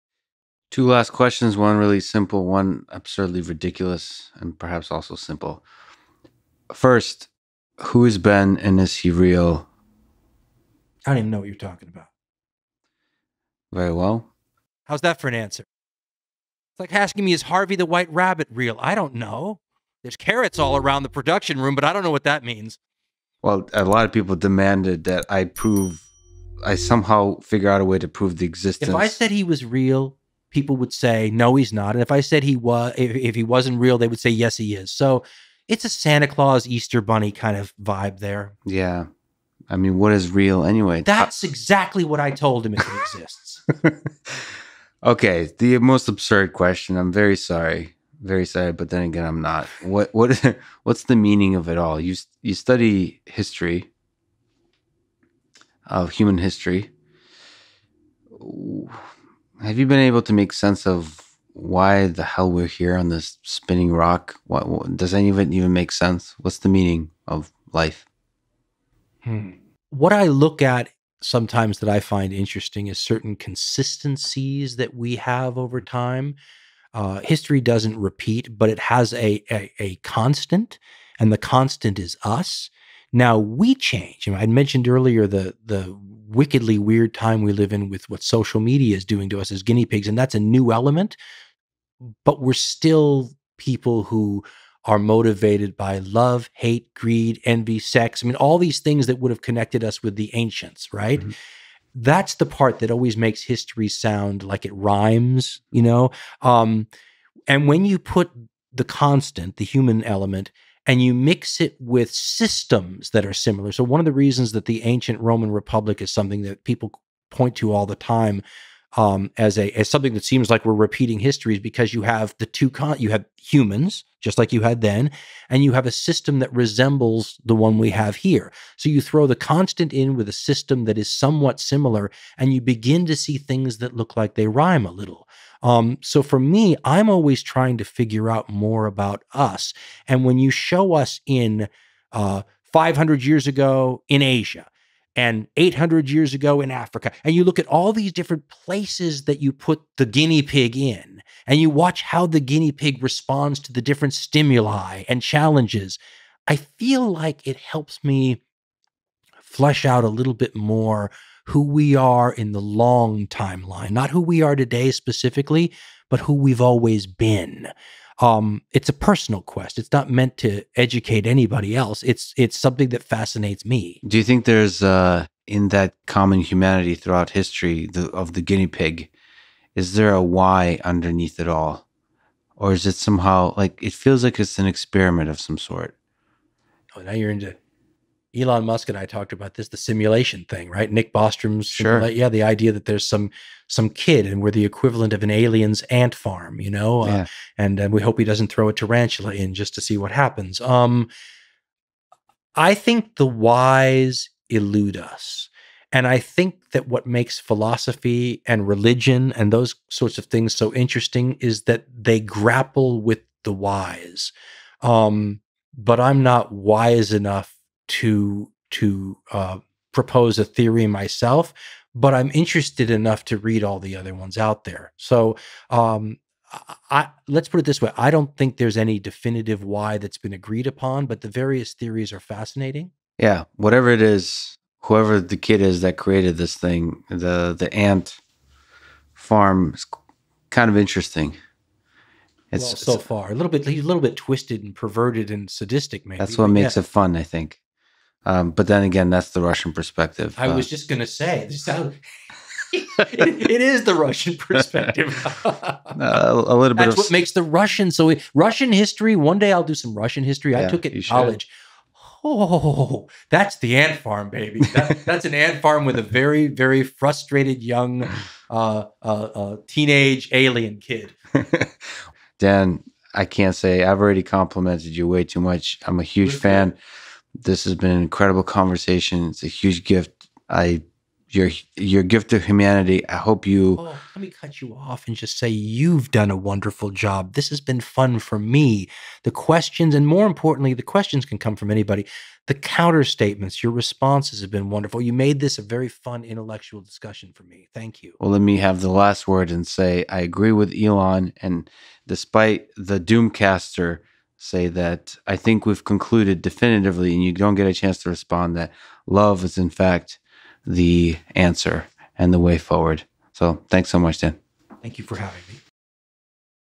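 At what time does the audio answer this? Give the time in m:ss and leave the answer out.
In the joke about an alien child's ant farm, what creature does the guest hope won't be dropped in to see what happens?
3:18.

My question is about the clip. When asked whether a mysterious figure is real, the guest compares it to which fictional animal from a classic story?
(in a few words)
Harvey.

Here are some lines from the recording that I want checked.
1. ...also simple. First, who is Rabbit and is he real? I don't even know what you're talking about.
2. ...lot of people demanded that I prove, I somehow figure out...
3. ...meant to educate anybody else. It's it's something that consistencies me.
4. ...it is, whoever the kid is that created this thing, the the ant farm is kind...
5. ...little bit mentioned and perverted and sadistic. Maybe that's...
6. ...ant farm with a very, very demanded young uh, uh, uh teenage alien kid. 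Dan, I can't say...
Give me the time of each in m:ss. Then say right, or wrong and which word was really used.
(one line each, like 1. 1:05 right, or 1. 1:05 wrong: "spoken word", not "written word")
1. 0:04 wrong: "Ben", not "Rabbit"
2. 0:23 right
3. 2:50 wrong: "fascinates", not "consistencies"
4. 3:53 right
5. 4:03 wrong: "twisted", not "mentioned"
6. 4:25 wrong: "frustrated", not "demanded".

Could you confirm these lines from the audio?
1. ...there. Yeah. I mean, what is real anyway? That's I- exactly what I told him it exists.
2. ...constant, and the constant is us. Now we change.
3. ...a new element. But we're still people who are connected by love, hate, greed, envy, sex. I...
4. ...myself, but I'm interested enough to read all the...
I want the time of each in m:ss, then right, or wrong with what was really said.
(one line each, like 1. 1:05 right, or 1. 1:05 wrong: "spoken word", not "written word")
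1. 0:38 right
2. 1:19 right
3. 1:30 wrong: "motivated", not "connected"
4. 3:40 right.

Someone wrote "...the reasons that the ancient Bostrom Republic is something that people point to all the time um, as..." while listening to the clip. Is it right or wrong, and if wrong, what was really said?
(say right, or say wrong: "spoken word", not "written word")
wrong: "Roman", not "Bostrom".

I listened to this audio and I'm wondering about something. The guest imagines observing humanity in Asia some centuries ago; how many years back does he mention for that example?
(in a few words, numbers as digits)
500.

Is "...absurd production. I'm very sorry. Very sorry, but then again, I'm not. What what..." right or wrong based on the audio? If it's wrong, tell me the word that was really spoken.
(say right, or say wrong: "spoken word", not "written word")
wrong: "question", not "production".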